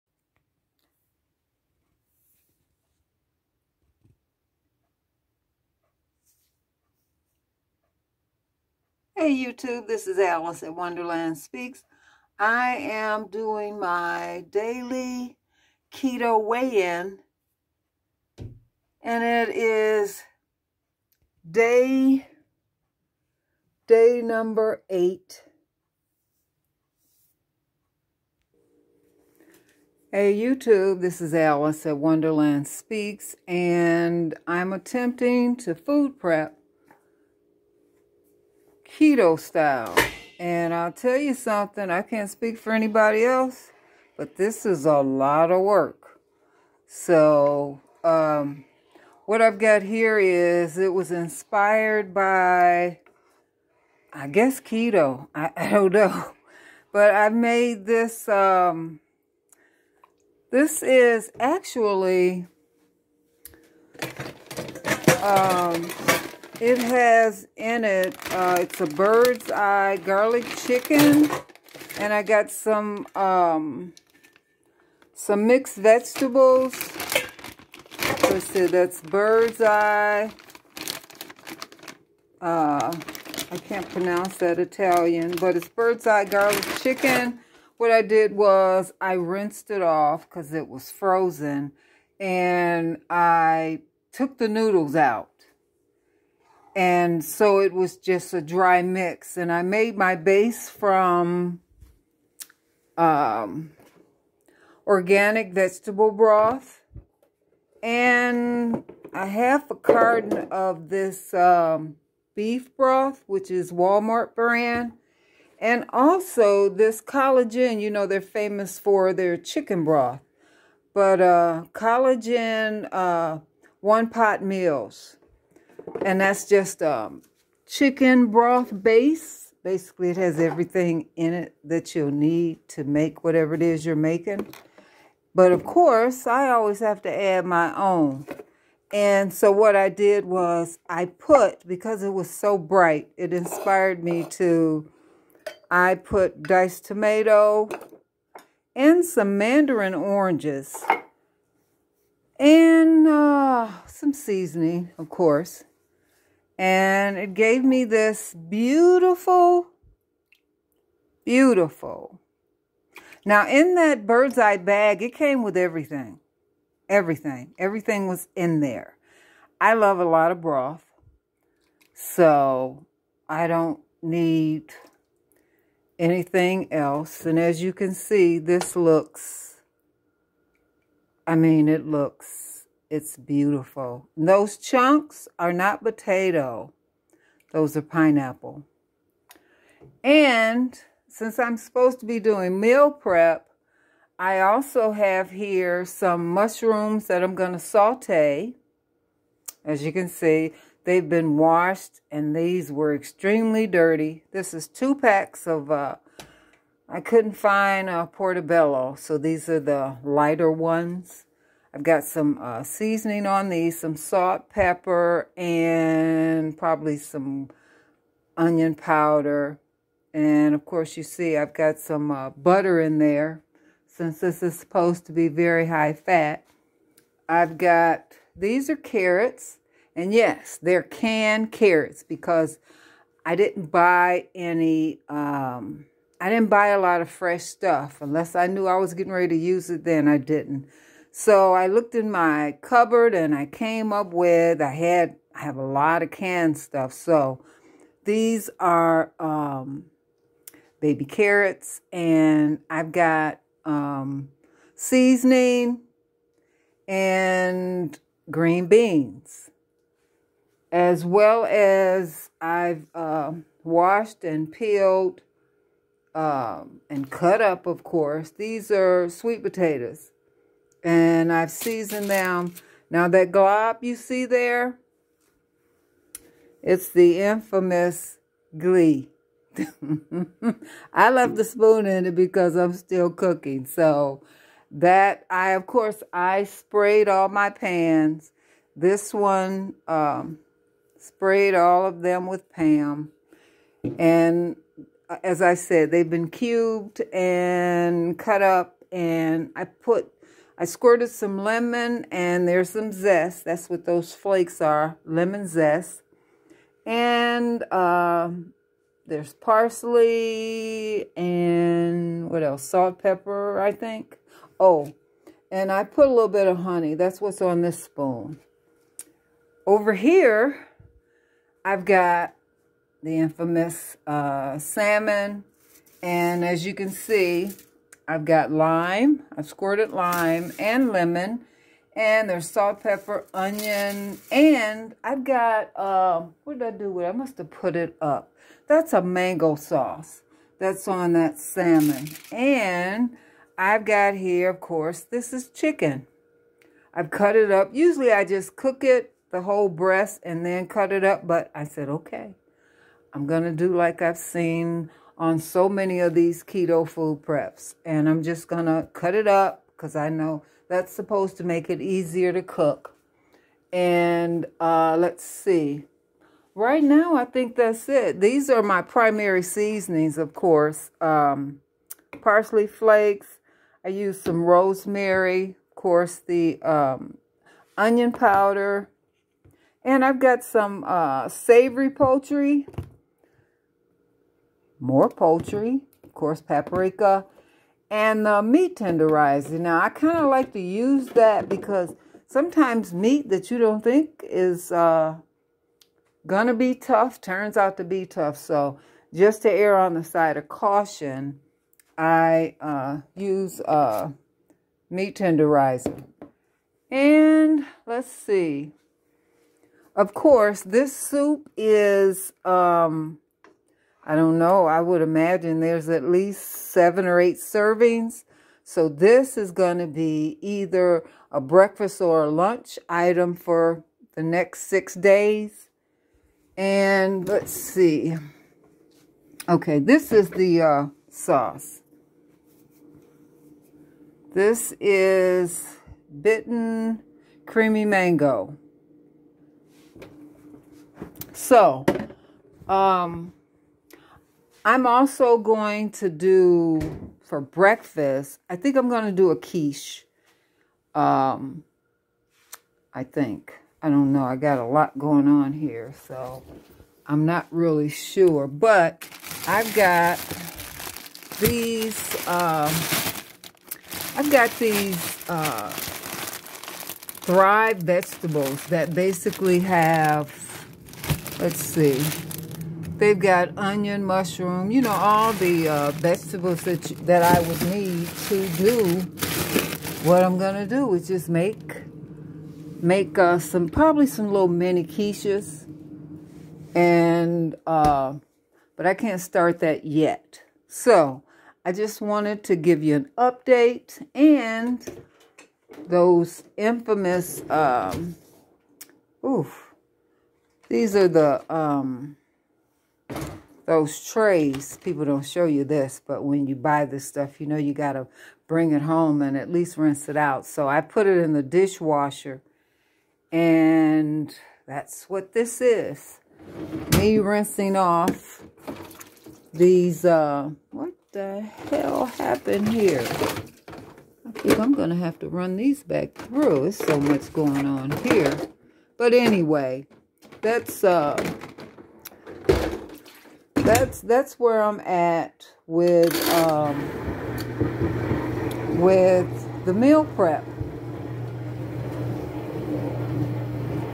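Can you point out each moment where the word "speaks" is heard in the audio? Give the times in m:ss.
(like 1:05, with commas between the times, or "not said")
0:11, 0:32, 0:42.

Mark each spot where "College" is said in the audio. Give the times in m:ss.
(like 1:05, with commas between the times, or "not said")
1:57, 2:01.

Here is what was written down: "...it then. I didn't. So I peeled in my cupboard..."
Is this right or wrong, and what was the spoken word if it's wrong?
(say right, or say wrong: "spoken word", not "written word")
wrong: "looked", not "peeled".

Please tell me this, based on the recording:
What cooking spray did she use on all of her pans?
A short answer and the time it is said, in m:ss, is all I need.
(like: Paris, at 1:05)
Pam, at 4:52.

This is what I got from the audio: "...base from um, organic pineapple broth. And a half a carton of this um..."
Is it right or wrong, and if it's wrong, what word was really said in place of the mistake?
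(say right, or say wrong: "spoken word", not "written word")
wrong: "vegetable", not "pineapple".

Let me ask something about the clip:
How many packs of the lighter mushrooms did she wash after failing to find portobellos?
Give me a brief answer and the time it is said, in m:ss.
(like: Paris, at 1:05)
2, at 3:24.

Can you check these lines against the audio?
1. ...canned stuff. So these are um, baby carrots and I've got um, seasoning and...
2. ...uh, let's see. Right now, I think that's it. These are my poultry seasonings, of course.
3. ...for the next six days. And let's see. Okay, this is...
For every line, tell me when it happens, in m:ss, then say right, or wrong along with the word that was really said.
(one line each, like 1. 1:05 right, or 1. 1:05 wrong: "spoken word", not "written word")
1. 4:06 right
2. 6:04 wrong: "primary", not "poultry"
3. 7:03 right.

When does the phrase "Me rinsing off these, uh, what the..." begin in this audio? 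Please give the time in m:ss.
8:36.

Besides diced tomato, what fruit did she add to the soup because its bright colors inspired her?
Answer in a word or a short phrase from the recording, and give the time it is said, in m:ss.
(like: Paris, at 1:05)
Mandarin oranges, at 2:29.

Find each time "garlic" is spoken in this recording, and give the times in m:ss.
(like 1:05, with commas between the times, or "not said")
1:10, 1:26.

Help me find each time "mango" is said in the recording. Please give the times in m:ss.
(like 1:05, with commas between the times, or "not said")
5:39, 7:17.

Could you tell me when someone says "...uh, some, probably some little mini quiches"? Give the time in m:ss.
8:03.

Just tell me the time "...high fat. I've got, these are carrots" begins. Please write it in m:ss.
3:45.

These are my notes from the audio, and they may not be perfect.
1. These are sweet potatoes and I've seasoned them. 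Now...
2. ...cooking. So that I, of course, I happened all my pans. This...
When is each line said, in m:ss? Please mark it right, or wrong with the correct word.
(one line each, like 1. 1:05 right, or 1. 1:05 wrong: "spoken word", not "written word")
1. 4:28 right
2. 4:43 wrong: "sprayed", not "happened".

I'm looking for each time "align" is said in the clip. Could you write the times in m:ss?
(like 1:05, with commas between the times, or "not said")
not said.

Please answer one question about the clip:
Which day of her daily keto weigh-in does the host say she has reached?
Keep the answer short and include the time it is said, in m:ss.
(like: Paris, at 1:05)
8, at 0:24.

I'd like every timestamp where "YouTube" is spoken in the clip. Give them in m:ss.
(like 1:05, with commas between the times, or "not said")
0:09, 0:30.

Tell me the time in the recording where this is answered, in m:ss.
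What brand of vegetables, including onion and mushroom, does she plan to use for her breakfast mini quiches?
7:47.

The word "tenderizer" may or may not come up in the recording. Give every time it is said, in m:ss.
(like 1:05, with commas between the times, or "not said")
6:28, 6:45.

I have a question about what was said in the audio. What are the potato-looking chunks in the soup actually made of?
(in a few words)
Pineapple.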